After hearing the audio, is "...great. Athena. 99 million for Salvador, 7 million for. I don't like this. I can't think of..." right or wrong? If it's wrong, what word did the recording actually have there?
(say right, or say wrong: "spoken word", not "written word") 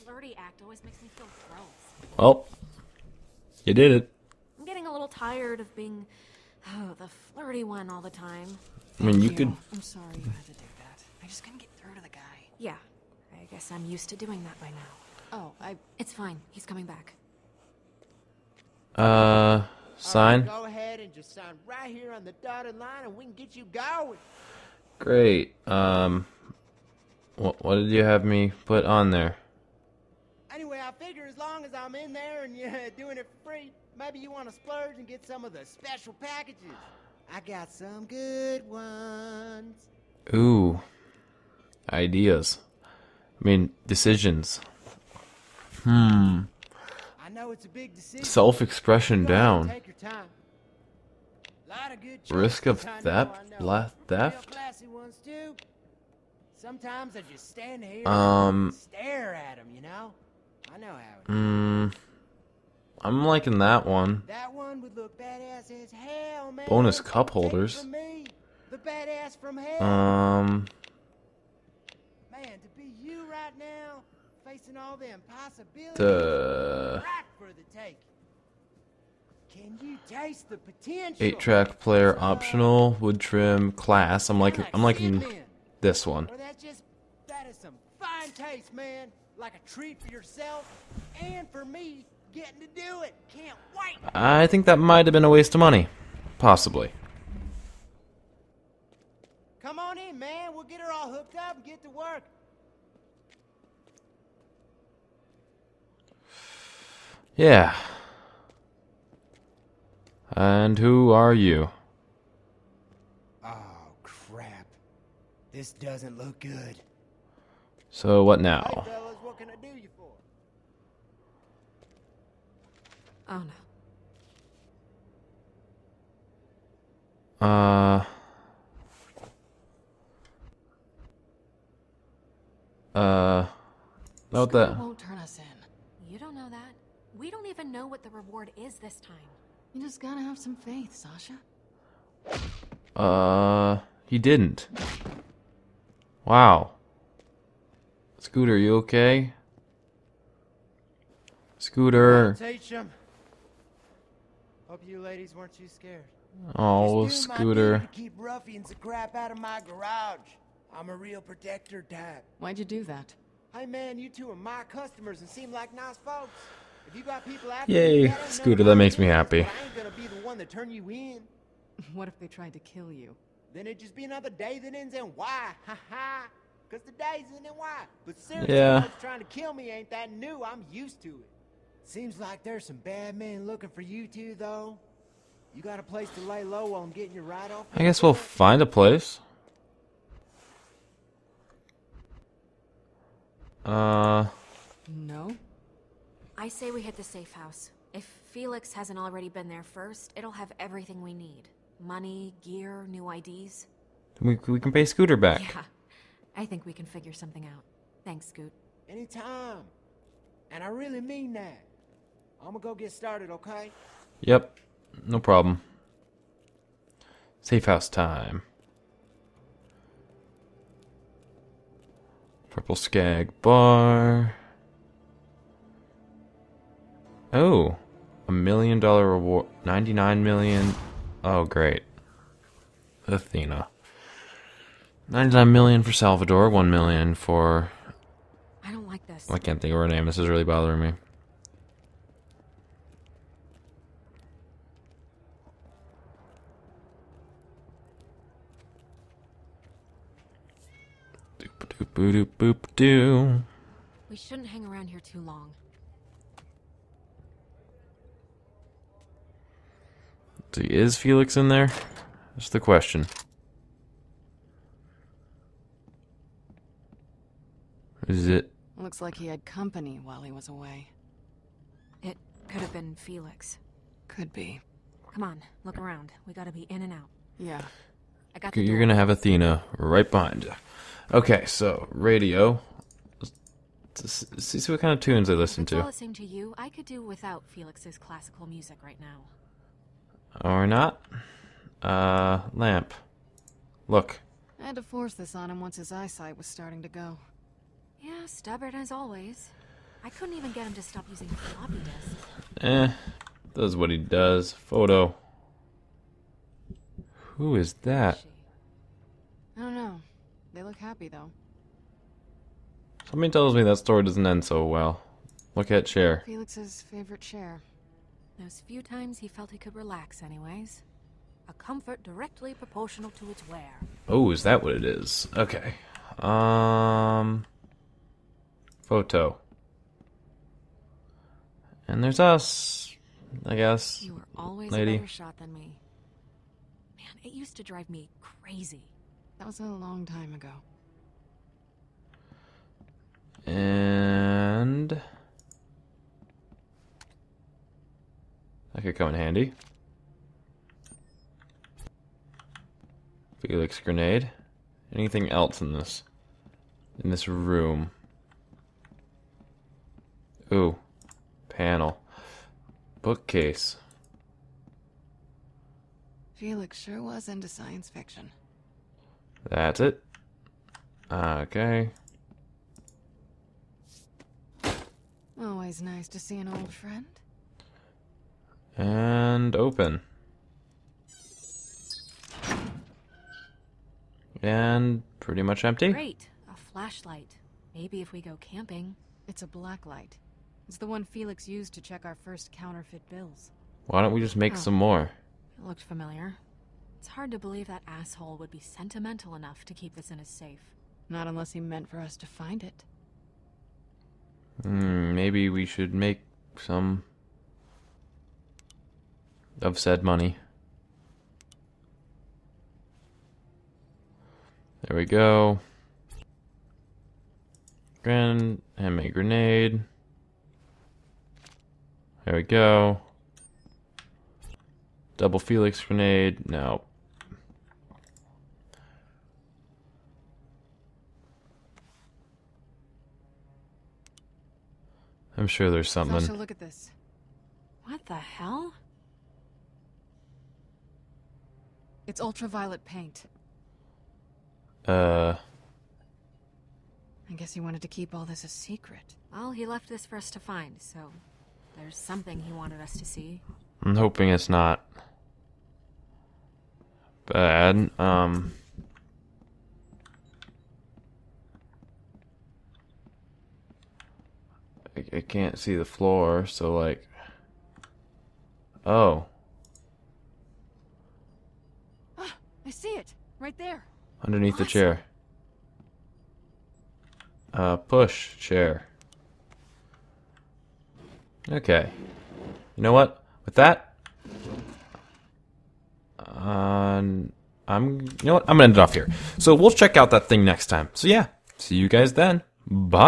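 wrong: "1", not "7".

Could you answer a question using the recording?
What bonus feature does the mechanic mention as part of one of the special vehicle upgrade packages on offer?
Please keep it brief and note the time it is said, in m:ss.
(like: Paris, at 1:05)
Cup holders, at 1:06.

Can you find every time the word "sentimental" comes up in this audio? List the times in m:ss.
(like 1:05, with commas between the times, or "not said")
6:38.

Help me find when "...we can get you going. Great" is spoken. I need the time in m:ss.
0:23.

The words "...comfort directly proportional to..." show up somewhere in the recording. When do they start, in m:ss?
5:21.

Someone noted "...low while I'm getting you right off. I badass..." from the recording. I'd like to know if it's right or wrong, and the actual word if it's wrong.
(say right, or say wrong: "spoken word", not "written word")
wrong: "guess", not "badass".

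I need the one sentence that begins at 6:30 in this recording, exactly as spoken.
It's the one Felix used to check our first counterfeit bills.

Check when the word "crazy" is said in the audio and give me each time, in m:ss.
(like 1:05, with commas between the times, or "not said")
5:38.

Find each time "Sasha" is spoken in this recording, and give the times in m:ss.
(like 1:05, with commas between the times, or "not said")
2:20, 7:16.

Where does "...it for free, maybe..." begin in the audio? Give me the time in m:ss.
0:33.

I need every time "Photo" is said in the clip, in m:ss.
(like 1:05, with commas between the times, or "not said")
5:04, 5:28.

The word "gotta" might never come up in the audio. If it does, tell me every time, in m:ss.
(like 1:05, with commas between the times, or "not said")
2:20, 4:36.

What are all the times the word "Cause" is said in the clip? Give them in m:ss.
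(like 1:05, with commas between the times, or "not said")
2:56.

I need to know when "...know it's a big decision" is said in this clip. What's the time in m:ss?
0:47.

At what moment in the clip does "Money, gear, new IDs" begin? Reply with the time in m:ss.
3:21.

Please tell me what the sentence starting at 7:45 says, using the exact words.
I, can't see the floor, so like.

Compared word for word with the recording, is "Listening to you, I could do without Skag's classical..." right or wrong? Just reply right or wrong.
wrong.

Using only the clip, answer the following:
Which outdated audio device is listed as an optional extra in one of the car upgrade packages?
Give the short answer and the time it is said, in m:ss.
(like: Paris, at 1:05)
Eight track player, at 1:21.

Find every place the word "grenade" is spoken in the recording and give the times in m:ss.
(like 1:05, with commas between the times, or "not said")
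5:53, 6:59, 7:05.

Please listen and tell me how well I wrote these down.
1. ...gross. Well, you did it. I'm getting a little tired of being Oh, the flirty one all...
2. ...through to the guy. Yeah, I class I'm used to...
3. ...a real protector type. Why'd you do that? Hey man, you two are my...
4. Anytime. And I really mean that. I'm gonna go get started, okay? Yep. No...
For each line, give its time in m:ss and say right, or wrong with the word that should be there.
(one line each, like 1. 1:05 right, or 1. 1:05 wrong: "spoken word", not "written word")
1. 0:01 right
2. 0:11 wrong: "guess", not "class"
3. 2:40 right
4. 3:28 right.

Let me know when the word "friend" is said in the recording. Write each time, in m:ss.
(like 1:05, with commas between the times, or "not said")
6:16.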